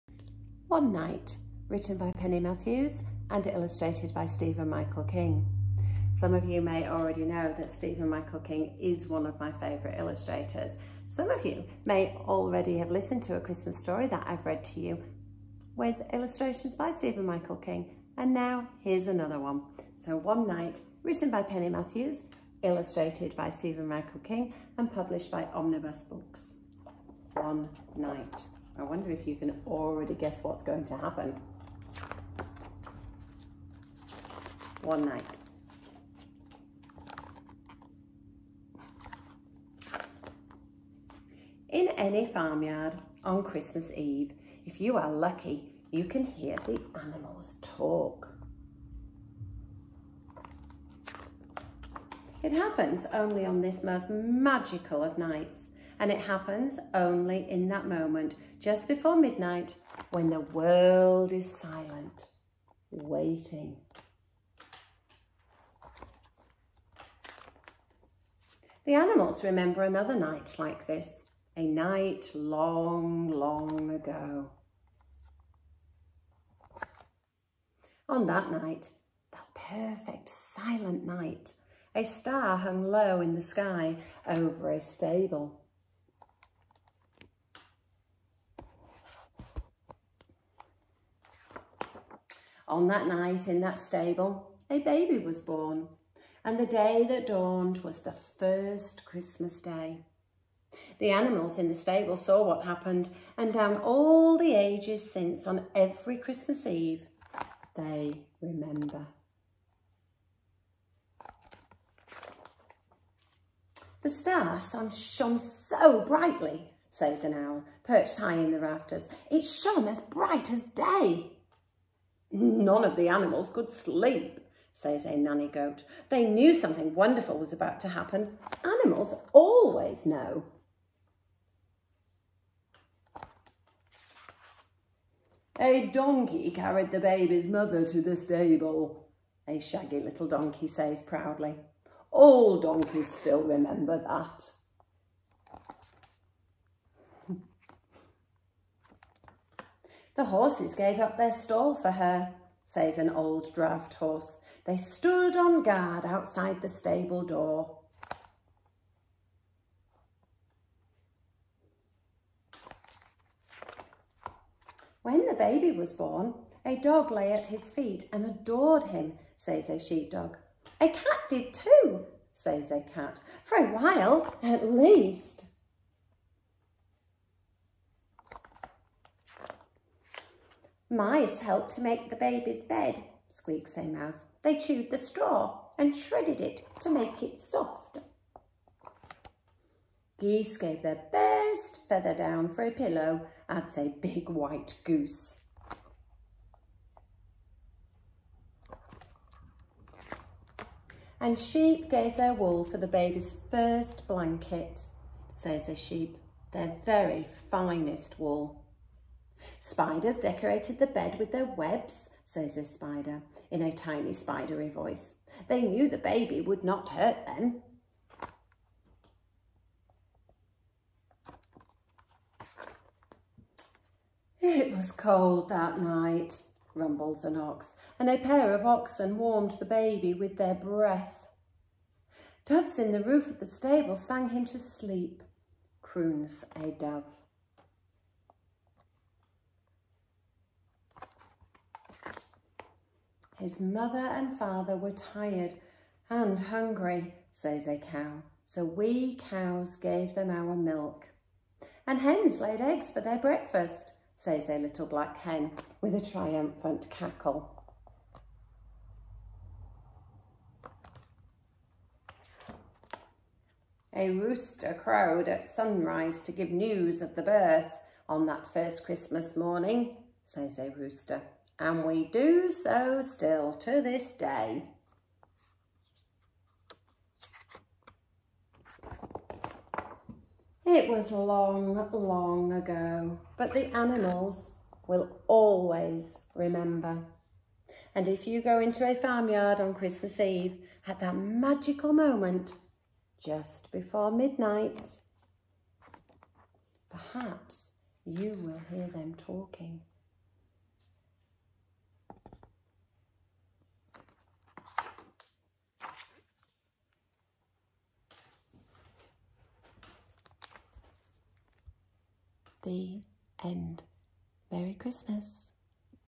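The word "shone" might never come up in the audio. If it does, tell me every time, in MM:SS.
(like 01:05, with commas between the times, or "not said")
01:54, 01:59.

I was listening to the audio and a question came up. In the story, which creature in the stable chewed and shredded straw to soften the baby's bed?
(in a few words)
Mice.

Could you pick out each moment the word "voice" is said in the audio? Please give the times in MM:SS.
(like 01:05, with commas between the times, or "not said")
03:34.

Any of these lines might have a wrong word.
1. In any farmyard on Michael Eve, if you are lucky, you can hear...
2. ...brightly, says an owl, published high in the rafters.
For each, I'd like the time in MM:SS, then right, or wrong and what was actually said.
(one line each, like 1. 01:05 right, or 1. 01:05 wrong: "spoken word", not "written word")
1. 00:41 wrong: "Christmas", not "Michael"
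2. 01:56 wrong: "perched", not "published".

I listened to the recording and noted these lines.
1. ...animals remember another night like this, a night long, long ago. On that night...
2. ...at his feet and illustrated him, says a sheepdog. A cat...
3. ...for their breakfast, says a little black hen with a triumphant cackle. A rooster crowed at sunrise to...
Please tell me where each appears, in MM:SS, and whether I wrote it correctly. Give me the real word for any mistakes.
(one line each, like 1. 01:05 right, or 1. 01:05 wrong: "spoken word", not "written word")
1. 01:08 right
2. 02:47 wrong: "adored", not "illustrated"
3. 04:12 right.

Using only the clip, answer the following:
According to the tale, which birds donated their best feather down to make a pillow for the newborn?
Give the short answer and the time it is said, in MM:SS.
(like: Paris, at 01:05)
Geese, at 03:10.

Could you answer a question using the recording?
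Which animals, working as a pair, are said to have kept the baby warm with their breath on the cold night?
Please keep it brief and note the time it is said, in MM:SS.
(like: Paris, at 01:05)
oxen, at 03:48.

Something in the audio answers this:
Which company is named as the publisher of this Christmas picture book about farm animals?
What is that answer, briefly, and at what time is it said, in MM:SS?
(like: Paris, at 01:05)
Omnibus Books, at 00:25.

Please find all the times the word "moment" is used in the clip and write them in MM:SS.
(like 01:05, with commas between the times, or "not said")
00:57, 04:51.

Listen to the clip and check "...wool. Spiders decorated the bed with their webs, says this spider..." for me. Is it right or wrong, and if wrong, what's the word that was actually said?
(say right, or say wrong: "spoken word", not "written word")
right.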